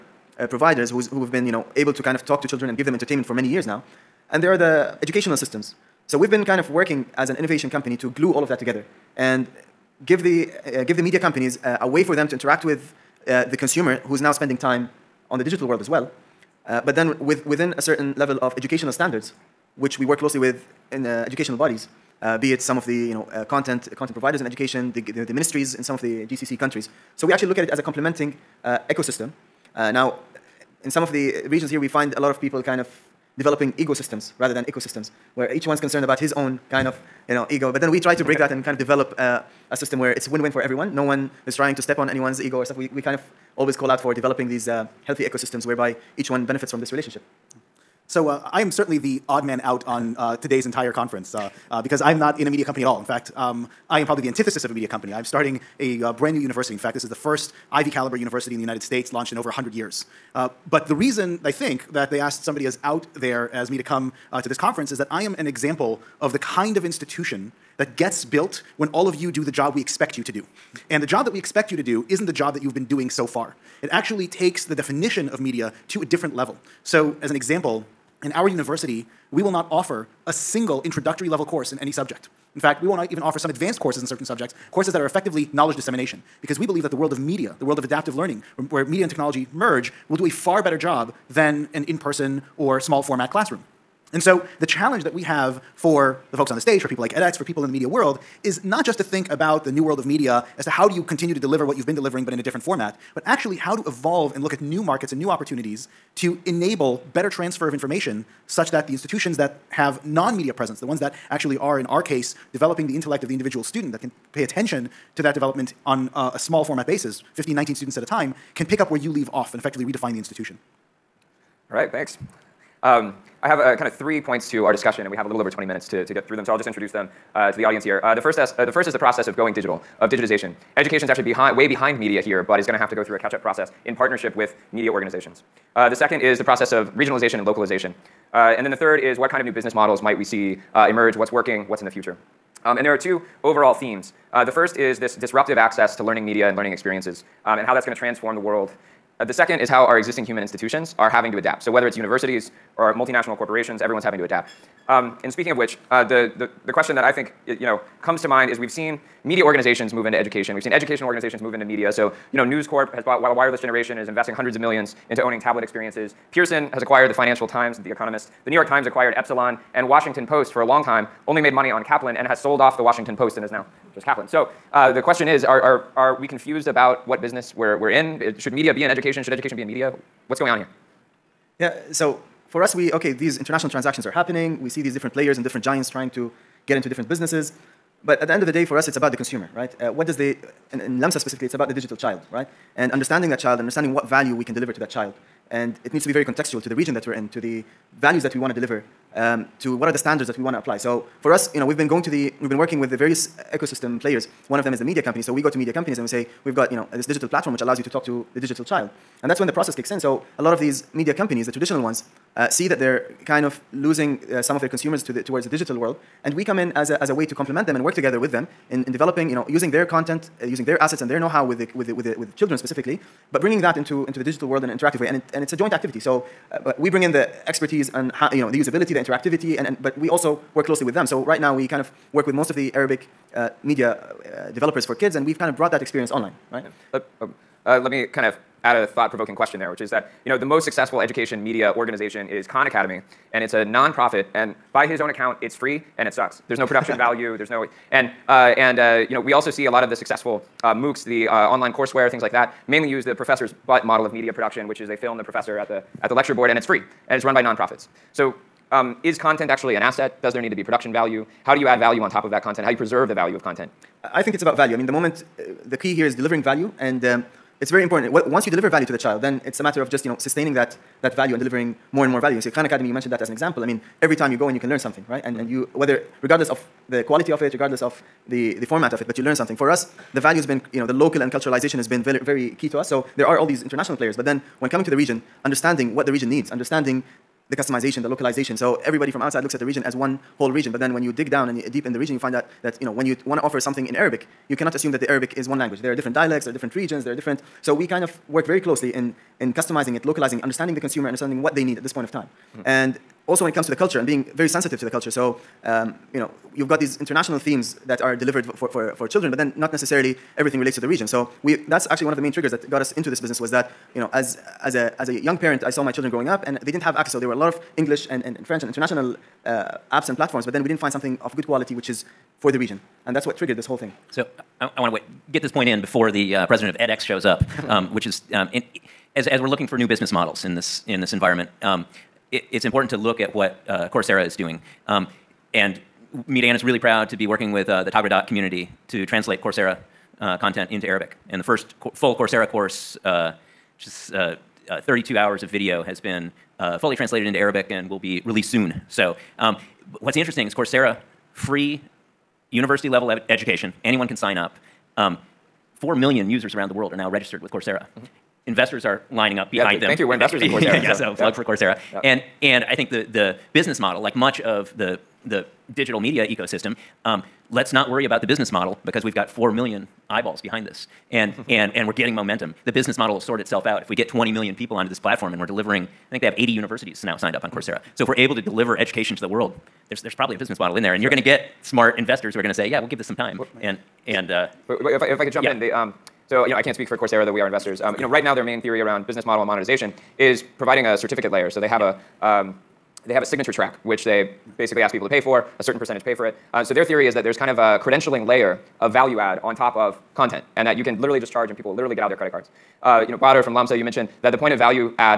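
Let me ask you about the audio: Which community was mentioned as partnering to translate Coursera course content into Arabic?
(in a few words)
Taghreedat.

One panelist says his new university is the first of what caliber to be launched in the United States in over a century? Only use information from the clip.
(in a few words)
Ivy caliber.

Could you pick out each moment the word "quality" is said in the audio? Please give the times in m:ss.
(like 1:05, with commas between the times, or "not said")
4:37, 5:21.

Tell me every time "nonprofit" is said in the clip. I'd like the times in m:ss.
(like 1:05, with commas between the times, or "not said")
4:03, 4:17.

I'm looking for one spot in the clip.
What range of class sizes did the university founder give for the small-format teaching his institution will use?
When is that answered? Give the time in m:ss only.
1:57.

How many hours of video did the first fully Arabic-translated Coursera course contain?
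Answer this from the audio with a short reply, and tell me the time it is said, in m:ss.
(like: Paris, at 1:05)
32, at 5:44.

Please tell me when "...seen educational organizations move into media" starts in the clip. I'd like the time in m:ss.
2:40.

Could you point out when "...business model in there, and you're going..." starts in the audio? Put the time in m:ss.
6:20.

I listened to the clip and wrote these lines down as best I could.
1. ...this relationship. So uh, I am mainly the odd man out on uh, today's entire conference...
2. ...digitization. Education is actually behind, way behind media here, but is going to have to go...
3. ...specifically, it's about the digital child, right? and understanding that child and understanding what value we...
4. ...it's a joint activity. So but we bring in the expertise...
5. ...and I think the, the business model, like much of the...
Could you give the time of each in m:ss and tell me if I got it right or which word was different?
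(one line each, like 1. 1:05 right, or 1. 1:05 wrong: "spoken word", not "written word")
1. 0:46 wrong: "certainly", not "mainly"
2. 2:10 right
3. 3:11 right
4. 3:45 right
5. 6:02 right.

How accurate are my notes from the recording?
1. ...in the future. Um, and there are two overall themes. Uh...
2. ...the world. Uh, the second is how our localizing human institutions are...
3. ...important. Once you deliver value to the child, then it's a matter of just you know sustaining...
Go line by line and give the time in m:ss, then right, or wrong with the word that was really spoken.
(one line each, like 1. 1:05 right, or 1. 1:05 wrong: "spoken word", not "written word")
1. 2:21 right
2. 2:28 wrong: "existing", not "localizing"
3. 4:27 right.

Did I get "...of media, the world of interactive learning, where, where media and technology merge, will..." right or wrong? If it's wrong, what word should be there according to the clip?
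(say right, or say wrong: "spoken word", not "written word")
wrong: "adaptive", not "interactive".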